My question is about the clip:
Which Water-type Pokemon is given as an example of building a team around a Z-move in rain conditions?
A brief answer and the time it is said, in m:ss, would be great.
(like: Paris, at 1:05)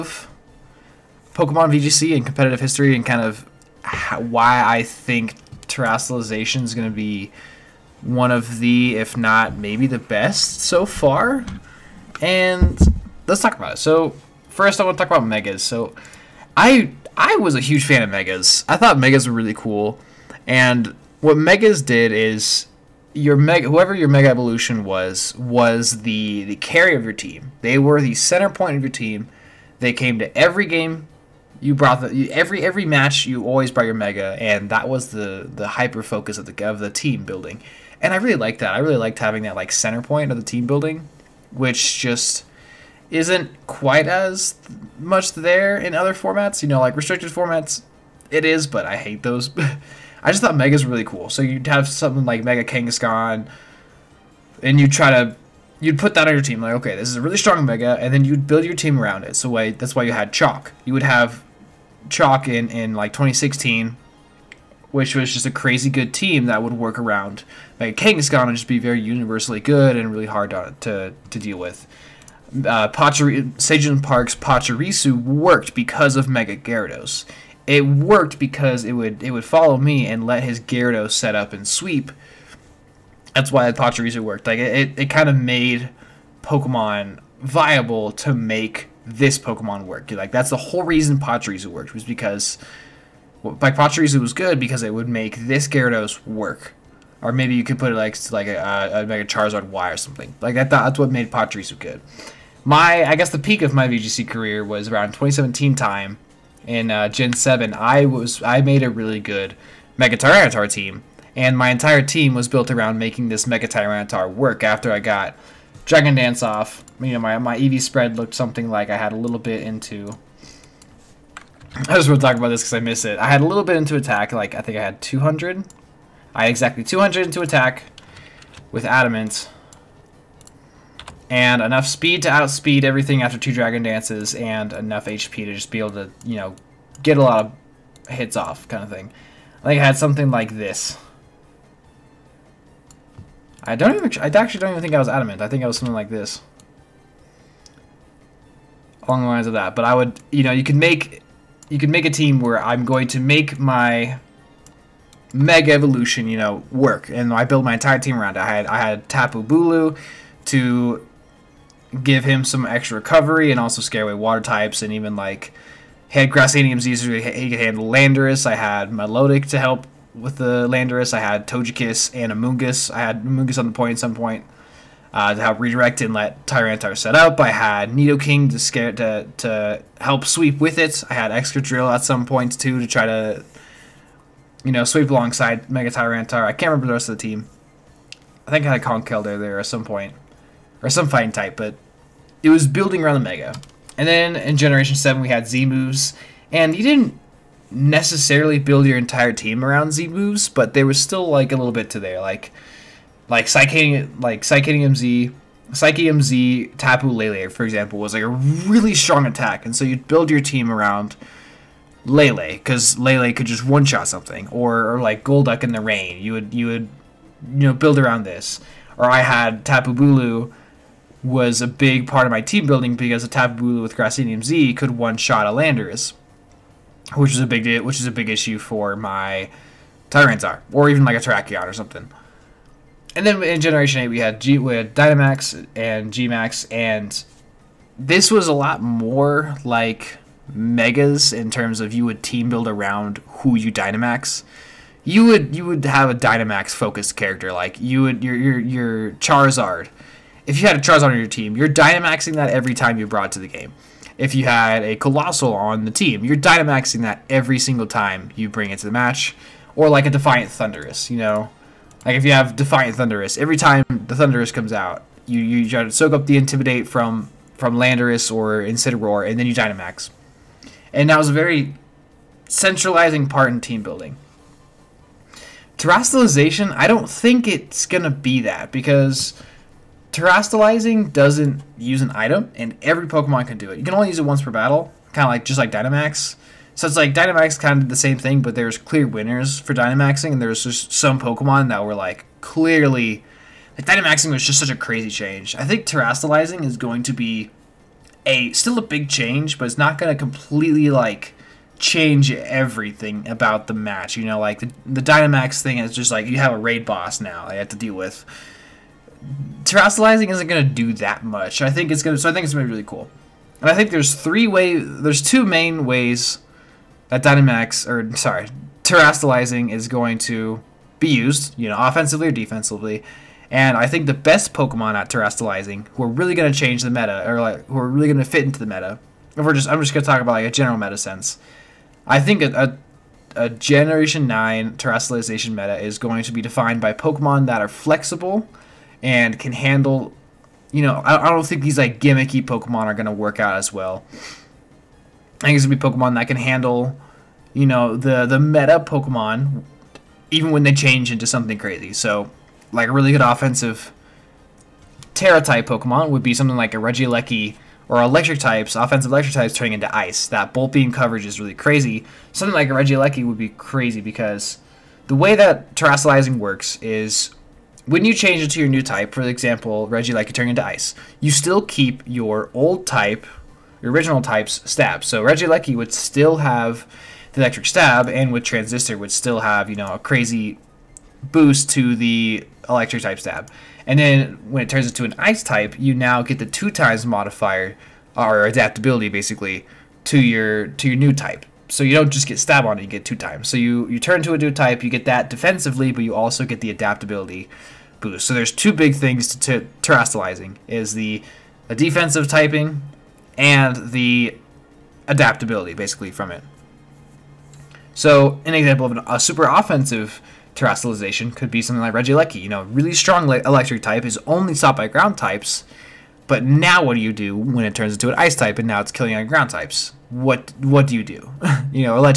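Golduck, at 3:35.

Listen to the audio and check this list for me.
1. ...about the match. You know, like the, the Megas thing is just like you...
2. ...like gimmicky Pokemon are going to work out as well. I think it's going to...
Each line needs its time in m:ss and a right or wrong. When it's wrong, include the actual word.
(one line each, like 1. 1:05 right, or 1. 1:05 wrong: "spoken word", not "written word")
1. 5:03 wrong: "Dynamax", not "Megas"
2. 5:41 right.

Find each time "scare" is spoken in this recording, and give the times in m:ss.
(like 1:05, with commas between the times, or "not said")
2:43, 2:58.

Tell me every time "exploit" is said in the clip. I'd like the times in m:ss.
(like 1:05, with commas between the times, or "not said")
not said.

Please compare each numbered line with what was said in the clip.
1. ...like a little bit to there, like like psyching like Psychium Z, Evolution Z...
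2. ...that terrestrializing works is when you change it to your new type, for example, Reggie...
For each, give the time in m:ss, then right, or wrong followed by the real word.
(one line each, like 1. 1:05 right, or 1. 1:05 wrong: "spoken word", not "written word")
1. 3:21 wrong: "Psychium", not "Evolution"
2. 6:05 right.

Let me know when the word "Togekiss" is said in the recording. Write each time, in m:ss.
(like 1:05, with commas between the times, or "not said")
2:51.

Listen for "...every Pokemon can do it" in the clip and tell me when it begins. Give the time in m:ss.
4:42.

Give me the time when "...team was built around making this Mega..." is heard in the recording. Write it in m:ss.
1:52.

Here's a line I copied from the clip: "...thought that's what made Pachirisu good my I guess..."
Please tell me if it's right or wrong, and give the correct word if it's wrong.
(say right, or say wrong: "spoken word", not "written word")
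right.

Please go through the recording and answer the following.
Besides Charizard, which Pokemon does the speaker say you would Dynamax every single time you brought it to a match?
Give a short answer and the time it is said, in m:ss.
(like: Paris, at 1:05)
Coalossal, at 4:14.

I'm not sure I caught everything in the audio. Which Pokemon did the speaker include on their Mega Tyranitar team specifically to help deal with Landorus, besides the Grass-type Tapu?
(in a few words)
Milotic.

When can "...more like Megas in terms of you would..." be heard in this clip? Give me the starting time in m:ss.
3:58.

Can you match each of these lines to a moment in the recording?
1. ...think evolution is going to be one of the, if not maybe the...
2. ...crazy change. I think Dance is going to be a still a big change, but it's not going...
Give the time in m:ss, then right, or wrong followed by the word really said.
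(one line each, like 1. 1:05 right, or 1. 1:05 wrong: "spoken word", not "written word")
1. 0:04 wrong: "terrestrialization", not "evolution"
2. 4:54 wrong: "Terastalizing", not "Dance".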